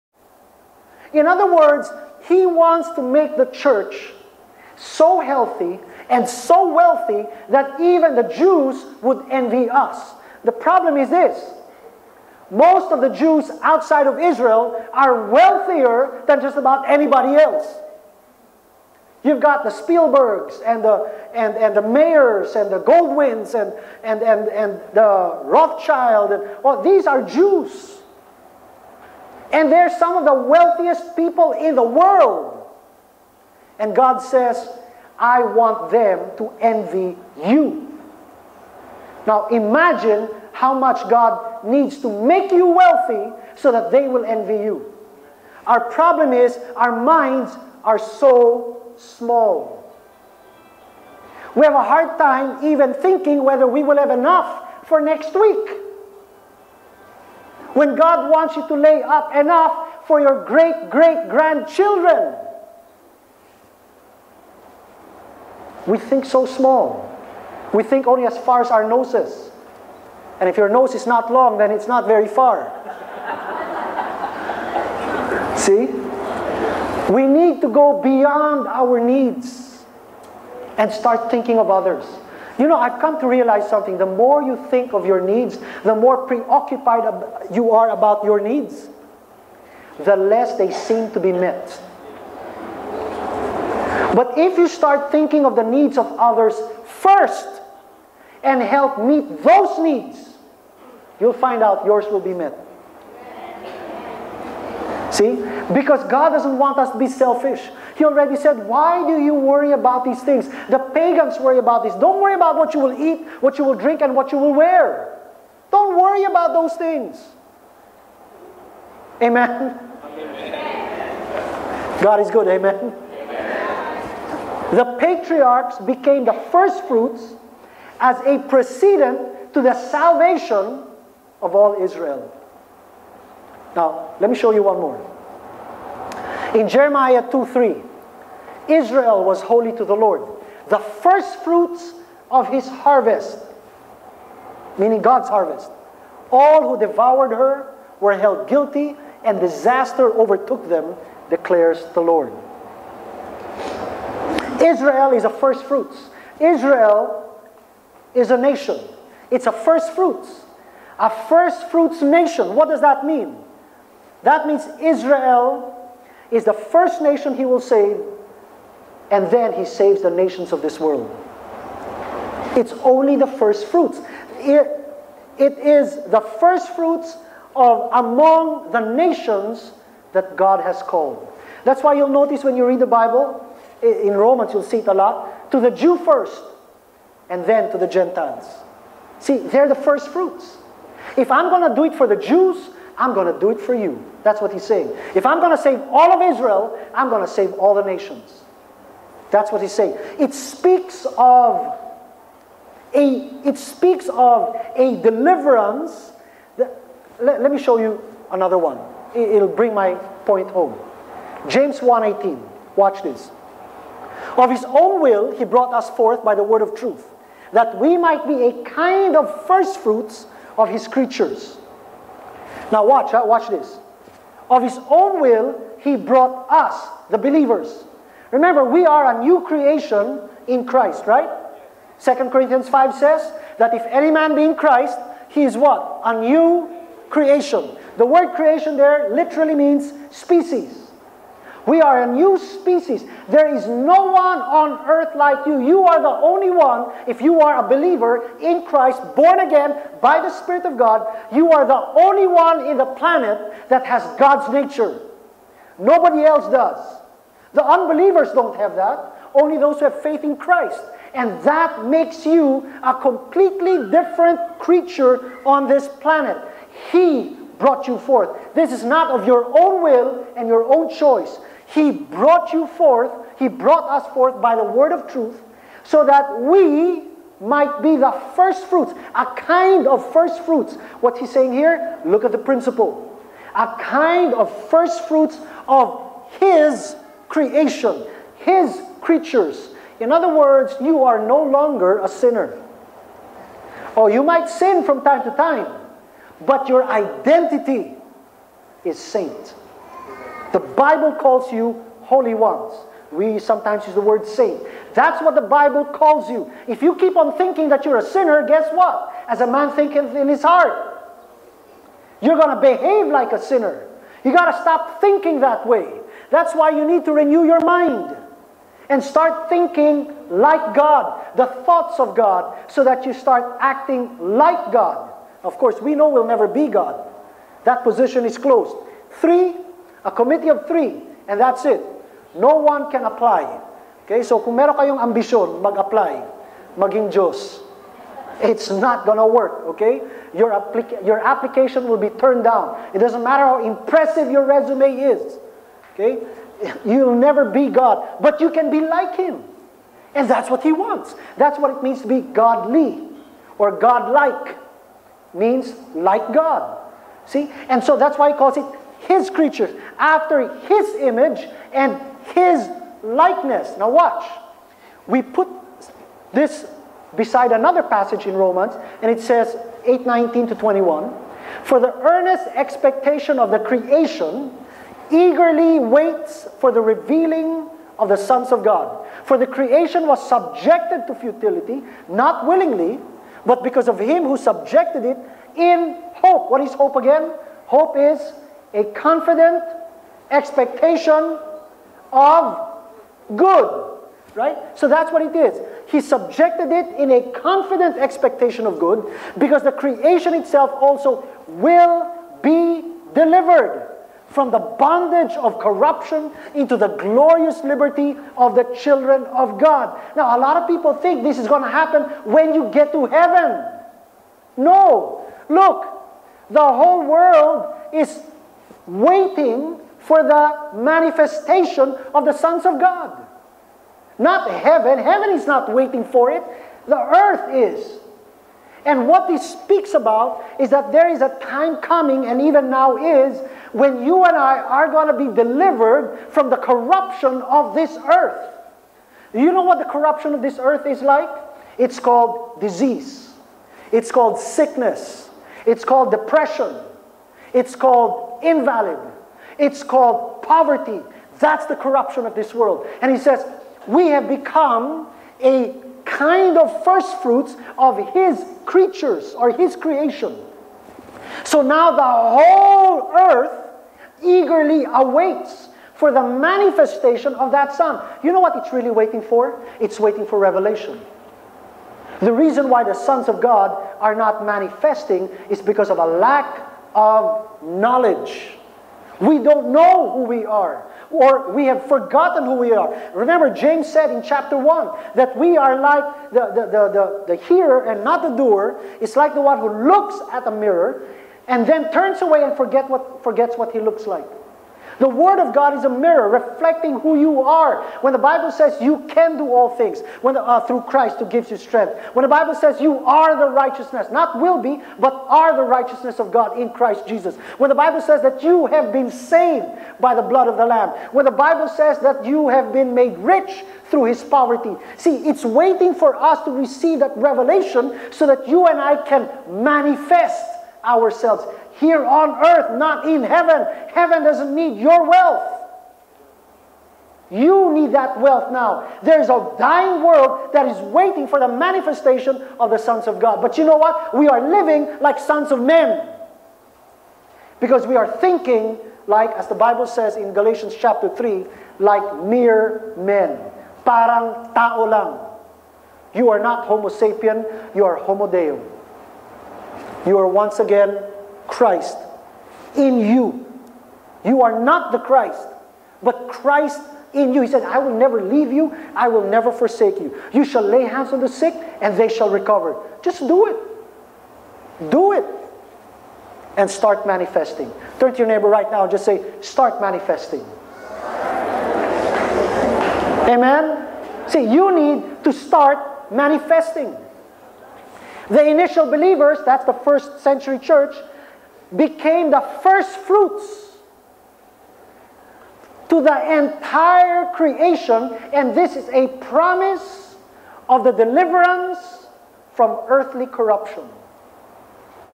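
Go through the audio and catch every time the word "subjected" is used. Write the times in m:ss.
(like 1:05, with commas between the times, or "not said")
6:20, 6:24, 6:36.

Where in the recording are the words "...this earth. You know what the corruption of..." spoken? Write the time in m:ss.
7:17.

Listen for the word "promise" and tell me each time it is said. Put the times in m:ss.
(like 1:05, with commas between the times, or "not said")
9:49.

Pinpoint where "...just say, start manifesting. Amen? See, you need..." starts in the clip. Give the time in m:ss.
9:28.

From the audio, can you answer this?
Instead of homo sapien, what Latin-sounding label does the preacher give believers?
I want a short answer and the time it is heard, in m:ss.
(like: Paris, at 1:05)
homo deum, at 9:07.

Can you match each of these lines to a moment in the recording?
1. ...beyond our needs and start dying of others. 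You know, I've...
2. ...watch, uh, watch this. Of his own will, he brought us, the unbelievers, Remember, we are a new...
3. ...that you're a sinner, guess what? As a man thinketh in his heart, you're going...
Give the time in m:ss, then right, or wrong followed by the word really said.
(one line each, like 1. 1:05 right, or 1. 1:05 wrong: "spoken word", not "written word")
1. 1:18 wrong: "thinking", not "dying"
2. 3:42 wrong: "believers", not "unbelievers"
3. 5:07 right.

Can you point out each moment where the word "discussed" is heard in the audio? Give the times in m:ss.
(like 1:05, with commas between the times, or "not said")
not said.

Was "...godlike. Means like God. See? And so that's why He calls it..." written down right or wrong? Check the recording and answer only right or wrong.
right.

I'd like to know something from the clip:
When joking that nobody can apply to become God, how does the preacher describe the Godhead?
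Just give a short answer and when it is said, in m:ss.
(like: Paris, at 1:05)
a committee of three, at 5:30.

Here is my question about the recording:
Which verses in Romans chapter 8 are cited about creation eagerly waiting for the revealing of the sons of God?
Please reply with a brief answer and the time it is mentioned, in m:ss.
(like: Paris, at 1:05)
8:19 to 21, at 6:09.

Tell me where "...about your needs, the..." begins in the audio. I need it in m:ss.
1:27.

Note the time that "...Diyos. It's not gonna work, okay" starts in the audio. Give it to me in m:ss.
5:37.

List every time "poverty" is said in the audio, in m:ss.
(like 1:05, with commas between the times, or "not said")
7:30, 8:34.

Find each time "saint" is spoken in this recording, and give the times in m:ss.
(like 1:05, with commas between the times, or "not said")
4:58, 5:04.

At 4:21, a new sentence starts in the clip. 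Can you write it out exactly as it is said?
And that makes you a completely different creature on this planet.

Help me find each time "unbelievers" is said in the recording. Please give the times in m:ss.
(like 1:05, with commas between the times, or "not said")
4:17.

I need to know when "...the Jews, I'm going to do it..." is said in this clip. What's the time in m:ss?
3:12.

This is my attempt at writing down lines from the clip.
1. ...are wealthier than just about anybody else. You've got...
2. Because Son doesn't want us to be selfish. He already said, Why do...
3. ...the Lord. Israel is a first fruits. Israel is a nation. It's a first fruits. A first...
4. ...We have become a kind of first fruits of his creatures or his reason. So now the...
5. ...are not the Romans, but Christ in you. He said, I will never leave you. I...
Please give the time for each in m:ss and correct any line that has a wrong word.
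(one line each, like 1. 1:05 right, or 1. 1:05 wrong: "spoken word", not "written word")
1. 0:14 right
2. 1:45 wrong: "God", not "Son"
3. 2:31 right
4. 7:33 wrong: "creation", not "reason"
5. 9:14 wrong: "Christ", not "Romans".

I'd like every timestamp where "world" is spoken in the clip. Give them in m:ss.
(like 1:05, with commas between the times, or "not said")
0:31, 2:50, 6:57, 7:32, 8:50.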